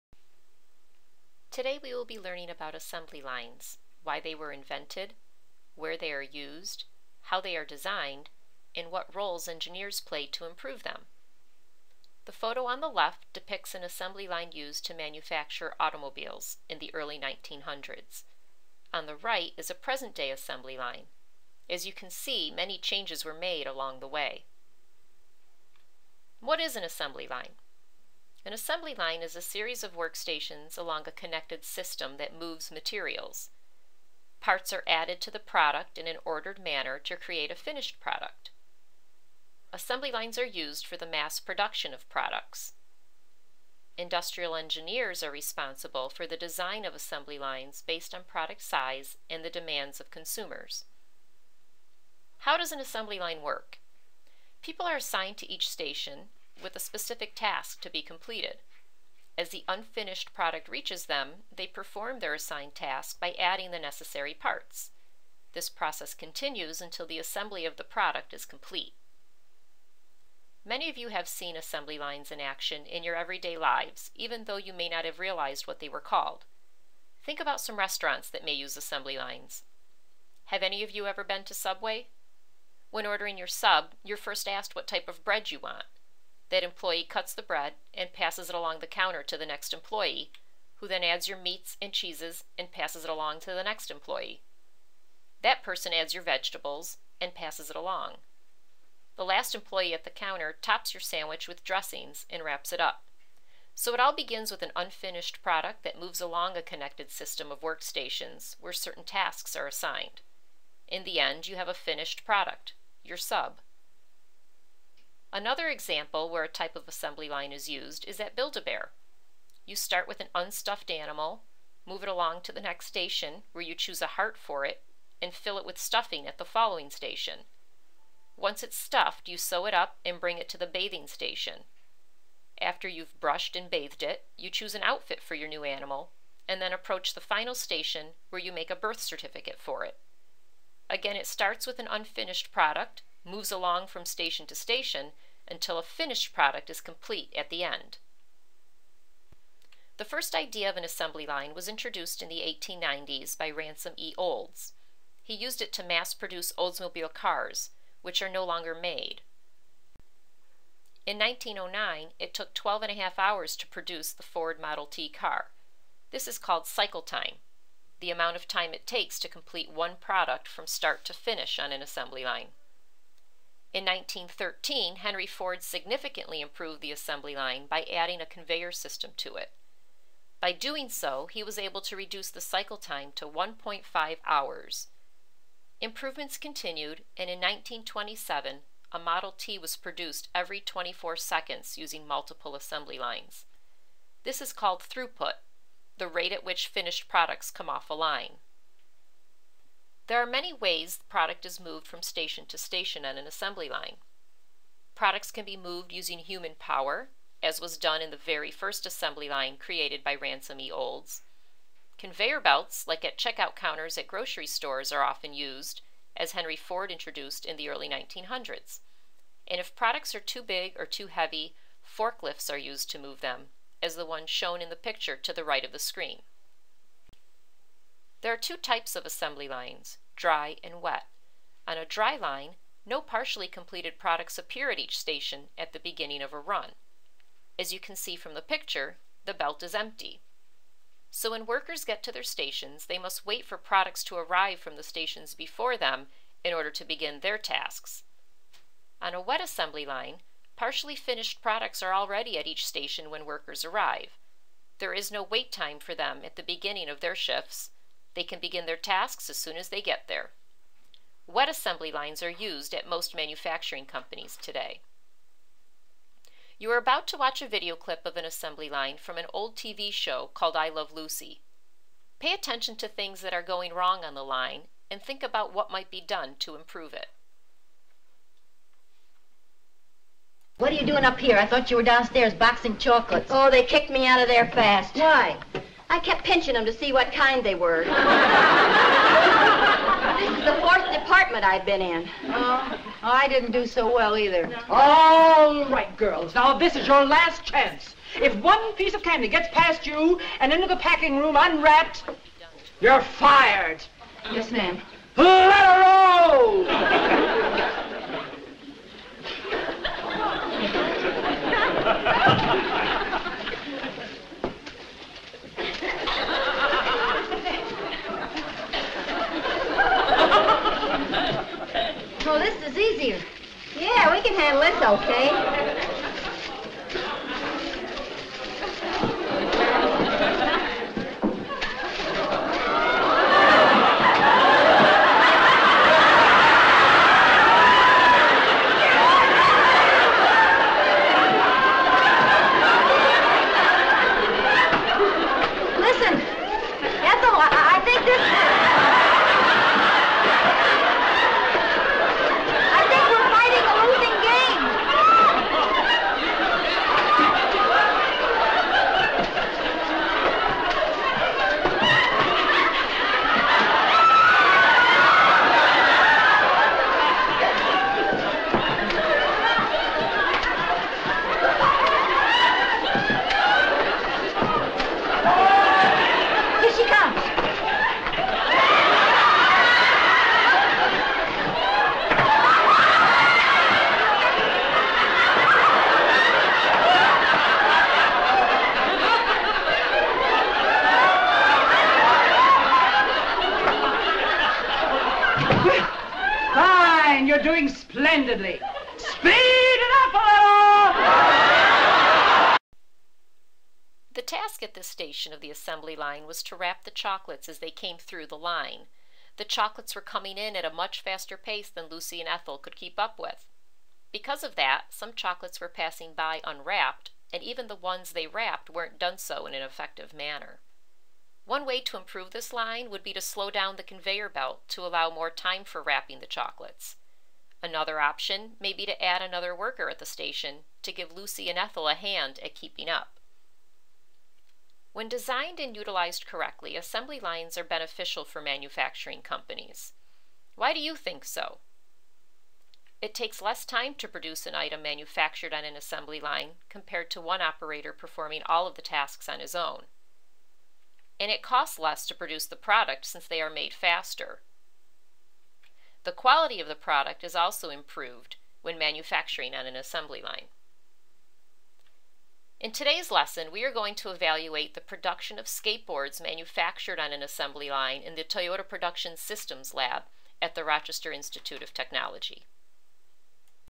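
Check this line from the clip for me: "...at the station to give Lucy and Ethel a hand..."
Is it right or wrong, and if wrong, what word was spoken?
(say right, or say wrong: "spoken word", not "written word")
right.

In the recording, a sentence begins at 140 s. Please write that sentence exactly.
Again, it starts with an unfinished product, moves along from station to station until a finished product is complete at the end.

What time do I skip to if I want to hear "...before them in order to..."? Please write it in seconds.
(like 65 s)
245 s.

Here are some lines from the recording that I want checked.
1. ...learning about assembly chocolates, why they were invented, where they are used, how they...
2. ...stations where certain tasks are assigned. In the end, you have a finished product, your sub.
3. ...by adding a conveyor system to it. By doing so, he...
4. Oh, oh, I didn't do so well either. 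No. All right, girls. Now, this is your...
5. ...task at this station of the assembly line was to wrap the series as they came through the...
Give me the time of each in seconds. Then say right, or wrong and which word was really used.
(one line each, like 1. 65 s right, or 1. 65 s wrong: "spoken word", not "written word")
1. 2 s wrong: "lines", not "chocolates"
2. 107 s wrong: "workstations", not "stations"
3. 177 s right
4. 292 s right
5. 404 s wrong: "chocolates", not "series".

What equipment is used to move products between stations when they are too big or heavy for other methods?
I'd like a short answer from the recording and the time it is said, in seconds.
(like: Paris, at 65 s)
forklifts, at 221 s.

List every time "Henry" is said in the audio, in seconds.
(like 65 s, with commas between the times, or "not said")
174 s, 216 s.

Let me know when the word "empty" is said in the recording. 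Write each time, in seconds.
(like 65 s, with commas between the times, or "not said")
239 s.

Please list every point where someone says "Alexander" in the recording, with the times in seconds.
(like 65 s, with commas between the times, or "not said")
not said.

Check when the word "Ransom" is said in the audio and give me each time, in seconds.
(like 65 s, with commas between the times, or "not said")
153 s, 210 s.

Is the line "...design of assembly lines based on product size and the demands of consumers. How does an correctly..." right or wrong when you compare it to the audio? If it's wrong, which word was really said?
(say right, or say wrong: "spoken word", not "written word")
wrong: "assembly", not "correctly".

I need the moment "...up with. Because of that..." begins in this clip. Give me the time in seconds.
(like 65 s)
412 s.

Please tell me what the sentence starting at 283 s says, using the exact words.
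Oh, they kicked me out of there fast.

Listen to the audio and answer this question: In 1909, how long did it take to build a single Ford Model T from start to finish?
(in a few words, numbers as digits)
12.5 hours.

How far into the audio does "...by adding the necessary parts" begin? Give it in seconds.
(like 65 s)
63 s.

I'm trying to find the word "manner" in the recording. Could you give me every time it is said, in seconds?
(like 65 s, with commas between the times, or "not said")
36 s, 420 s.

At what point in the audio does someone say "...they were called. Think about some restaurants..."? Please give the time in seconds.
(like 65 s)
75 s.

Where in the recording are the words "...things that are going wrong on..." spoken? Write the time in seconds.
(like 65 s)
272 s.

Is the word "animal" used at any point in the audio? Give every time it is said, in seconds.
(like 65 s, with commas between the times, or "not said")
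120 s, 135 s.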